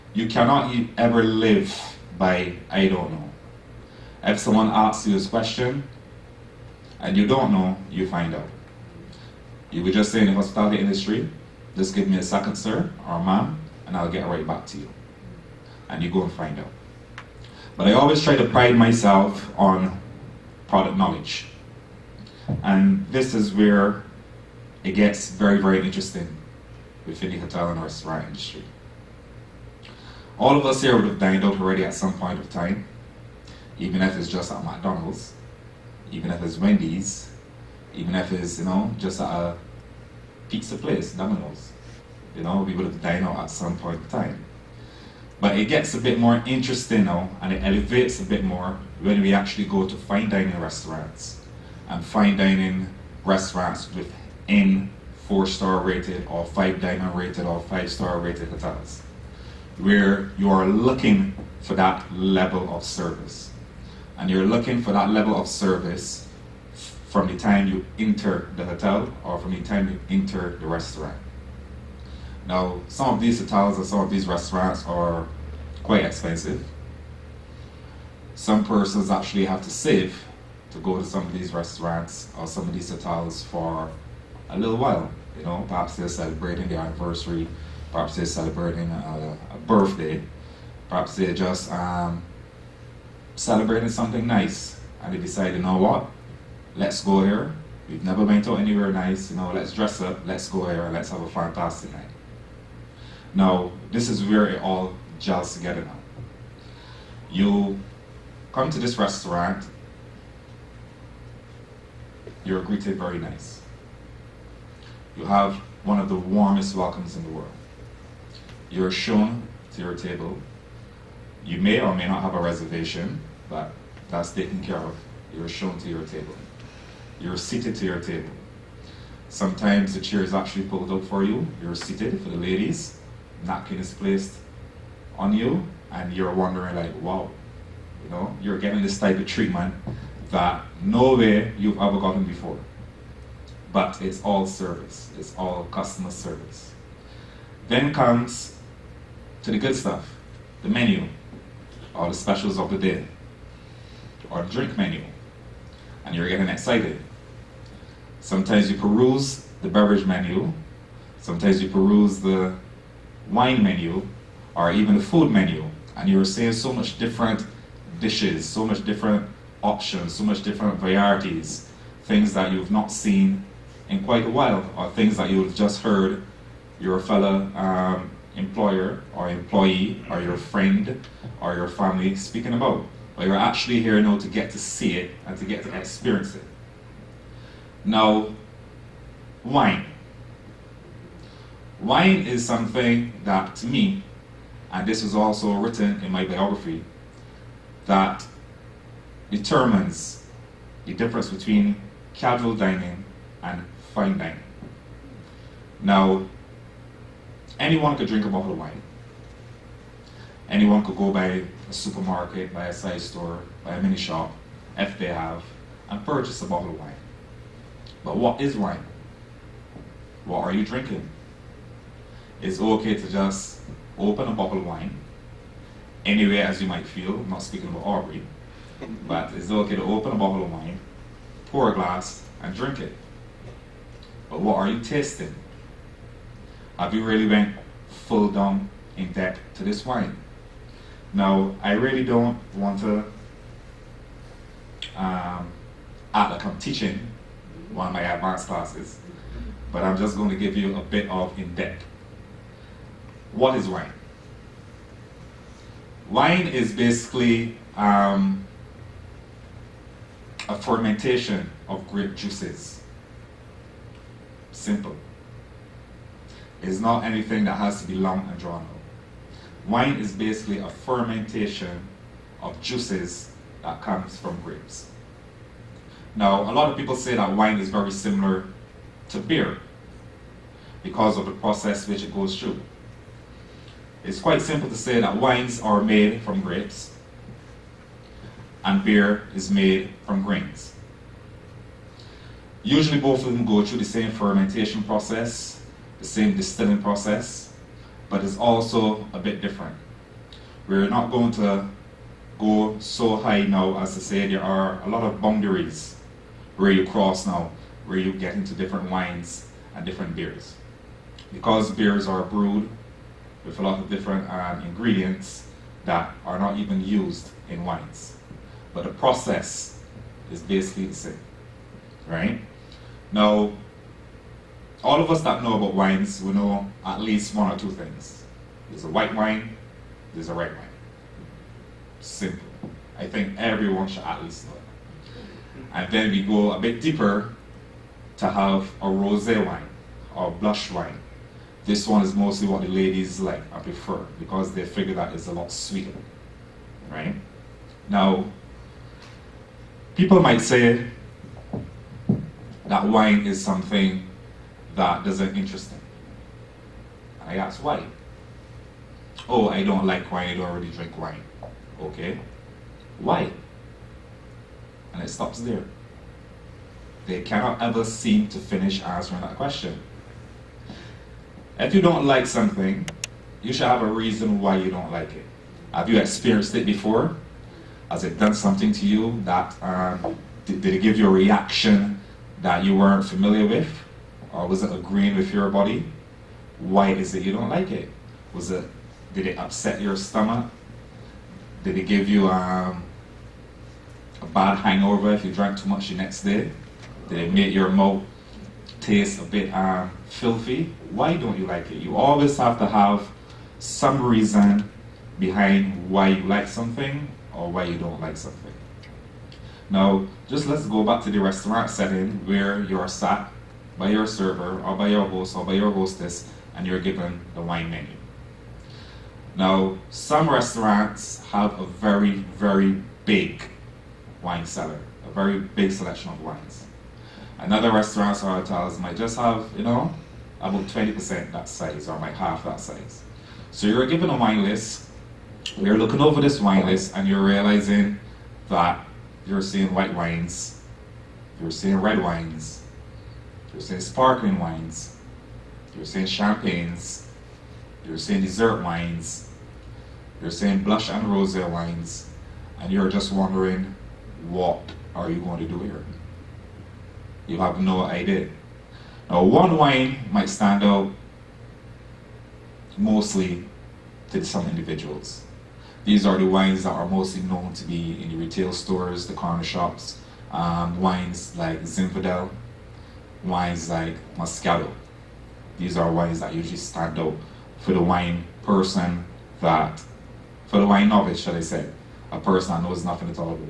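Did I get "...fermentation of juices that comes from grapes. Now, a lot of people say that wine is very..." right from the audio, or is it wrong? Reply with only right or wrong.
right.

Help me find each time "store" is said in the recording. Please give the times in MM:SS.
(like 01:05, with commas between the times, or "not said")
03:32, 07:48.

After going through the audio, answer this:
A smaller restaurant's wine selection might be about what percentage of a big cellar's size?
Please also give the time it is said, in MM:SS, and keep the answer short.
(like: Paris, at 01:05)
20%, at 07:10.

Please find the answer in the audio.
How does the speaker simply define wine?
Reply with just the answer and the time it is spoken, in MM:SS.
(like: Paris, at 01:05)
Fermentation of grape juices, at 04:20.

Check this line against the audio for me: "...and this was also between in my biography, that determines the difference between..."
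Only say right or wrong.
wrong.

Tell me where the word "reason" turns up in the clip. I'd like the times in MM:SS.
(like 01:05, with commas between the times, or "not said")
06:13, 06:44.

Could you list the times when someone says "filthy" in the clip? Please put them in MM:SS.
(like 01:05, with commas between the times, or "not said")
06:40.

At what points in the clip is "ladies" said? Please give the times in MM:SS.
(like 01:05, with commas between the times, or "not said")
02:12, 05:42.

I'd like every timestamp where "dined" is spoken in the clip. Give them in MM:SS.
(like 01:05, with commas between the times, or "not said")
00:31, 00:43.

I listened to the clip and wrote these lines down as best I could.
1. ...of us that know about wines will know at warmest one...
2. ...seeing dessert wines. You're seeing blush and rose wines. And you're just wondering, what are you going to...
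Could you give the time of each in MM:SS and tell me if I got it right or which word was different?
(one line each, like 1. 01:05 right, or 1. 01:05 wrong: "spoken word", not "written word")
1. 05:24 wrong: "least", not "warmest"
2. 07:27 right.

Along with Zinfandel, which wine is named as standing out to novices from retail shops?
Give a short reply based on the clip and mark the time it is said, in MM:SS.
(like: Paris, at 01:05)
Moscato, at 07:54.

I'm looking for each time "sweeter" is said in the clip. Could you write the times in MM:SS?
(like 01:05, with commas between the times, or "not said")
05:45.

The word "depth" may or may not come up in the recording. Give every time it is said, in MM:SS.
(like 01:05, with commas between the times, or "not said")
03:59, 04:11.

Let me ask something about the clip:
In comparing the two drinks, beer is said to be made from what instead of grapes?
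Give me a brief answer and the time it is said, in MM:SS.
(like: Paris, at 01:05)
Grains, at 04:50.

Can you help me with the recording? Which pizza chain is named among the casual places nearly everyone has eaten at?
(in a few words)
Domino's.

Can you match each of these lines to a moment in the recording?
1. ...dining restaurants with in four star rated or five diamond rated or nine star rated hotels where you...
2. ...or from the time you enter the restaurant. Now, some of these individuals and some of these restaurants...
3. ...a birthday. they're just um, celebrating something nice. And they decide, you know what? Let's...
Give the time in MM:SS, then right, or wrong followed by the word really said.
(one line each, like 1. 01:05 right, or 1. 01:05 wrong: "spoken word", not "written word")
1. 00:52 wrong: "five", not "nine"
2. 01:09 wrong: "hotels", not "individuals"
3. 01:29 right.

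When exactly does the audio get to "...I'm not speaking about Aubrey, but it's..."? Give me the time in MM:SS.
03:47.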